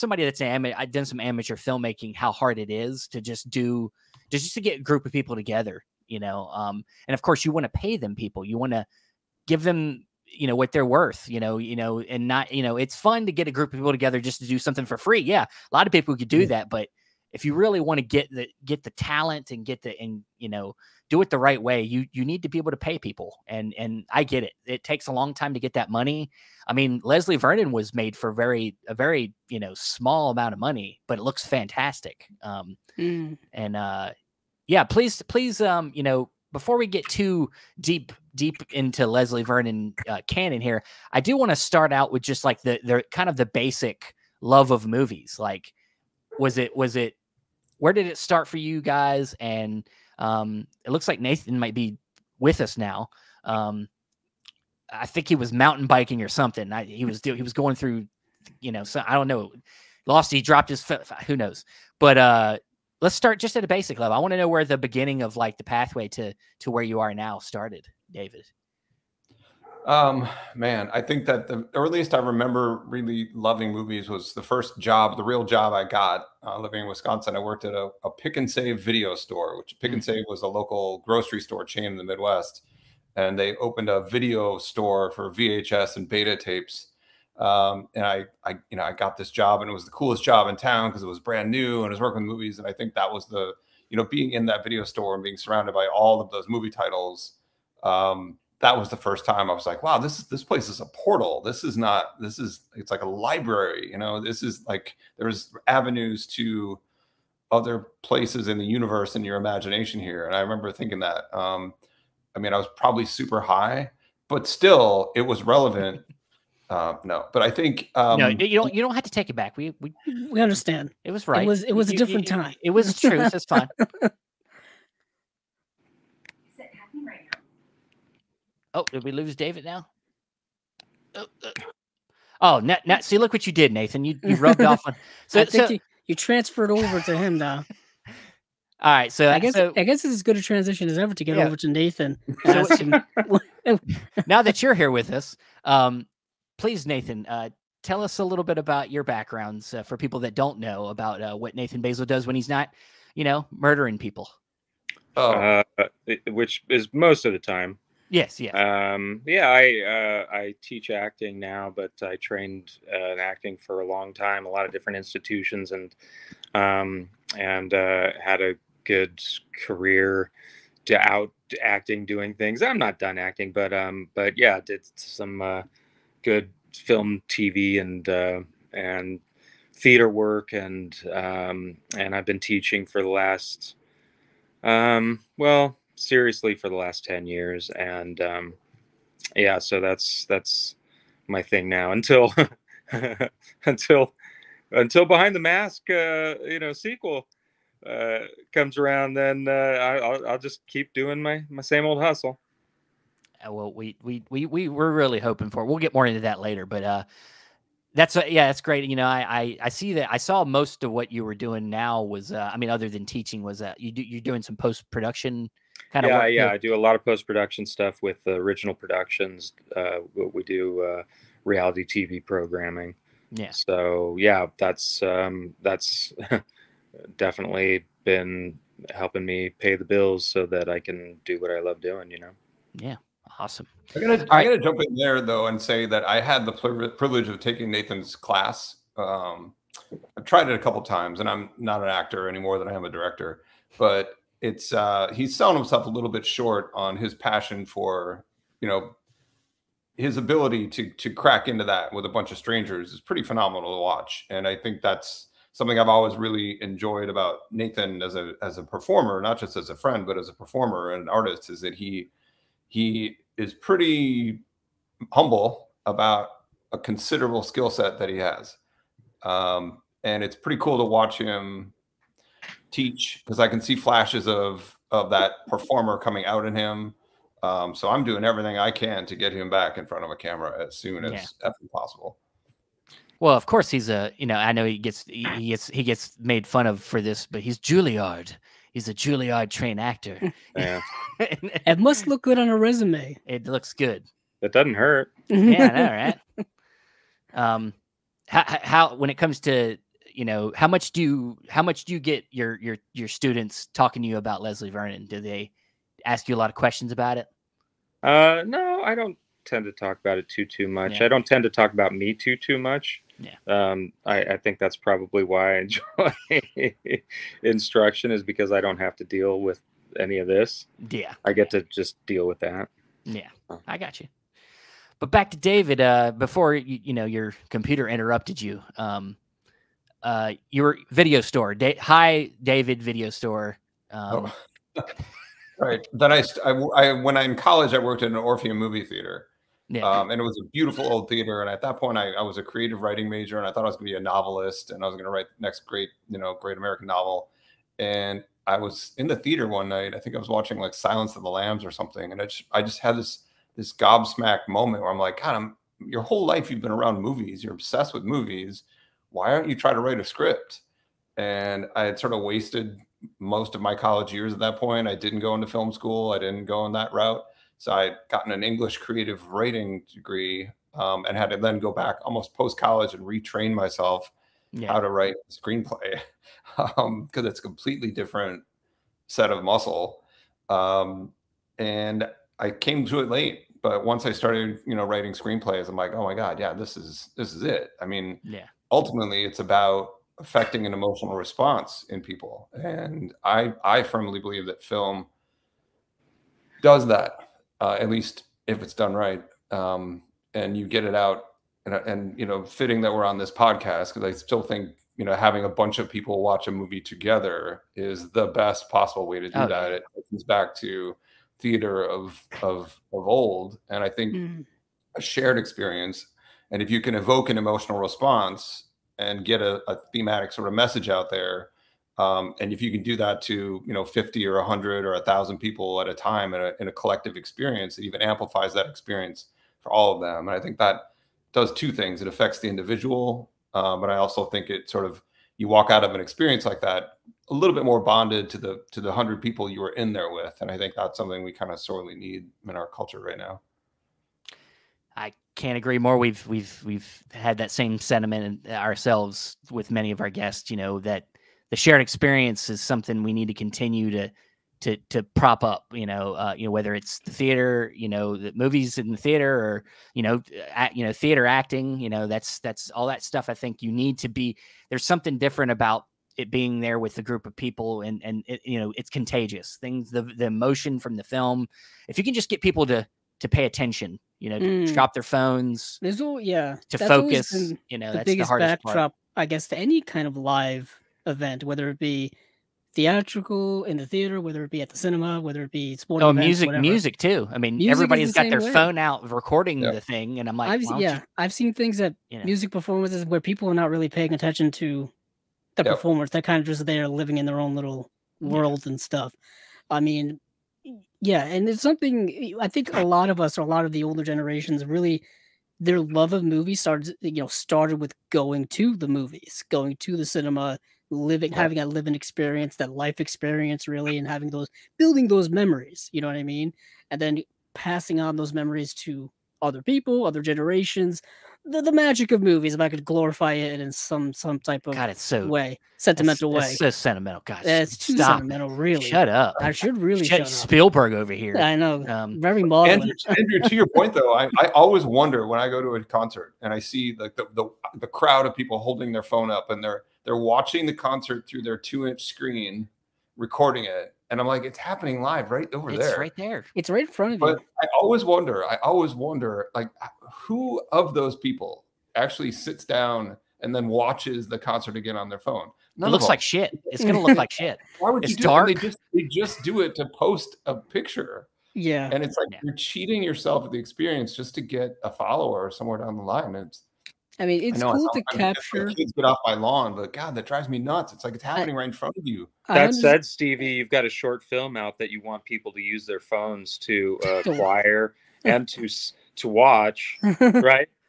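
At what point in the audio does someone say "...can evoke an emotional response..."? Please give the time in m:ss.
6:56.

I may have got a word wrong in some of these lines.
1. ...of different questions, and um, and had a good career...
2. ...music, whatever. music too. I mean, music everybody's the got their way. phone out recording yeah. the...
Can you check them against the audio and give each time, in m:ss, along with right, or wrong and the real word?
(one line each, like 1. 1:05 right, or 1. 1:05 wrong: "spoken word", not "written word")
1. 2:44 wrong: "institutions", not "questions"
2. 8:06 right.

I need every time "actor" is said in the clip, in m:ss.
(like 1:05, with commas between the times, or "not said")
4:01, 4:49.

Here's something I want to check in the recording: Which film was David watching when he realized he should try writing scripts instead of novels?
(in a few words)
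Silence of the Lambs.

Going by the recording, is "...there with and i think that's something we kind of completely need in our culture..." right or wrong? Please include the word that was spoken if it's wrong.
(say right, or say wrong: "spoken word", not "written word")
wrong: "sorely", not "completely".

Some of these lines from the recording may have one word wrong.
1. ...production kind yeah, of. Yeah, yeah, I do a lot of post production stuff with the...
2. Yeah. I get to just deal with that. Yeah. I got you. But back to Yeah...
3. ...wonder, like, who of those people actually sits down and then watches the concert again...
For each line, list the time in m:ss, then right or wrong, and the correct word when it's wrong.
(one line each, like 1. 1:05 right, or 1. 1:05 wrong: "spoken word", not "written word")
1. 3:34 right
2. 5:20 wrong: "David", not "Yeah"
3. 9:08 right.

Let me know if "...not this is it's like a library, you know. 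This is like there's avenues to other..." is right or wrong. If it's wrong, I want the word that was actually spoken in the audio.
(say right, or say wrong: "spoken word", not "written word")
right.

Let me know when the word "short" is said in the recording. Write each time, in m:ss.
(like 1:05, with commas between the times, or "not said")
4:06, 9:33.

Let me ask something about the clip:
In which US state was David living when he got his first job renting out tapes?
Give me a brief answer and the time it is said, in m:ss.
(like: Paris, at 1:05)
Wisconsin, at 1:16.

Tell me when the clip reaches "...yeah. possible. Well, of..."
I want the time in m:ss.
4:41.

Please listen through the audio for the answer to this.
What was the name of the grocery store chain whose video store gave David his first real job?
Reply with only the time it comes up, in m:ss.
1:18.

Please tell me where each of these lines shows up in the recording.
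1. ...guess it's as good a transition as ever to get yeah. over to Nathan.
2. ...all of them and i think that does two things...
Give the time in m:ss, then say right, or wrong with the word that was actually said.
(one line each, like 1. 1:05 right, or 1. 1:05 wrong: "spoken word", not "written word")
1. 2:19 right
2. 7:09 right.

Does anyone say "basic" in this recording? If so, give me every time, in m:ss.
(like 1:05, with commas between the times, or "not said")
0:43, 1:03.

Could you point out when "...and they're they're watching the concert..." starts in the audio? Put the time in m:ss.
8:59.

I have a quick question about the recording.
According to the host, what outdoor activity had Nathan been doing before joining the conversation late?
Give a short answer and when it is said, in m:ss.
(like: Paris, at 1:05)
Mountain biking, at 0:55.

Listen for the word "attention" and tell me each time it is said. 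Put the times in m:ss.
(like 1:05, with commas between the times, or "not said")
7:53, 8:14.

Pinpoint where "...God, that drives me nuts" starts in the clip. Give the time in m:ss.
9:29.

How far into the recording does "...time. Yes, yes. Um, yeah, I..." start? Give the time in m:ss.
2:37.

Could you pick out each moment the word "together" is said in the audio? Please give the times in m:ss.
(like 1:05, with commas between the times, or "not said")
0:05, 0:13, 6:46.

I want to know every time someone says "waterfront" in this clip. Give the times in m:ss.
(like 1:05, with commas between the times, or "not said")
not said.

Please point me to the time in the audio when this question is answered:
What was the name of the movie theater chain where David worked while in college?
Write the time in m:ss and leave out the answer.
5:38.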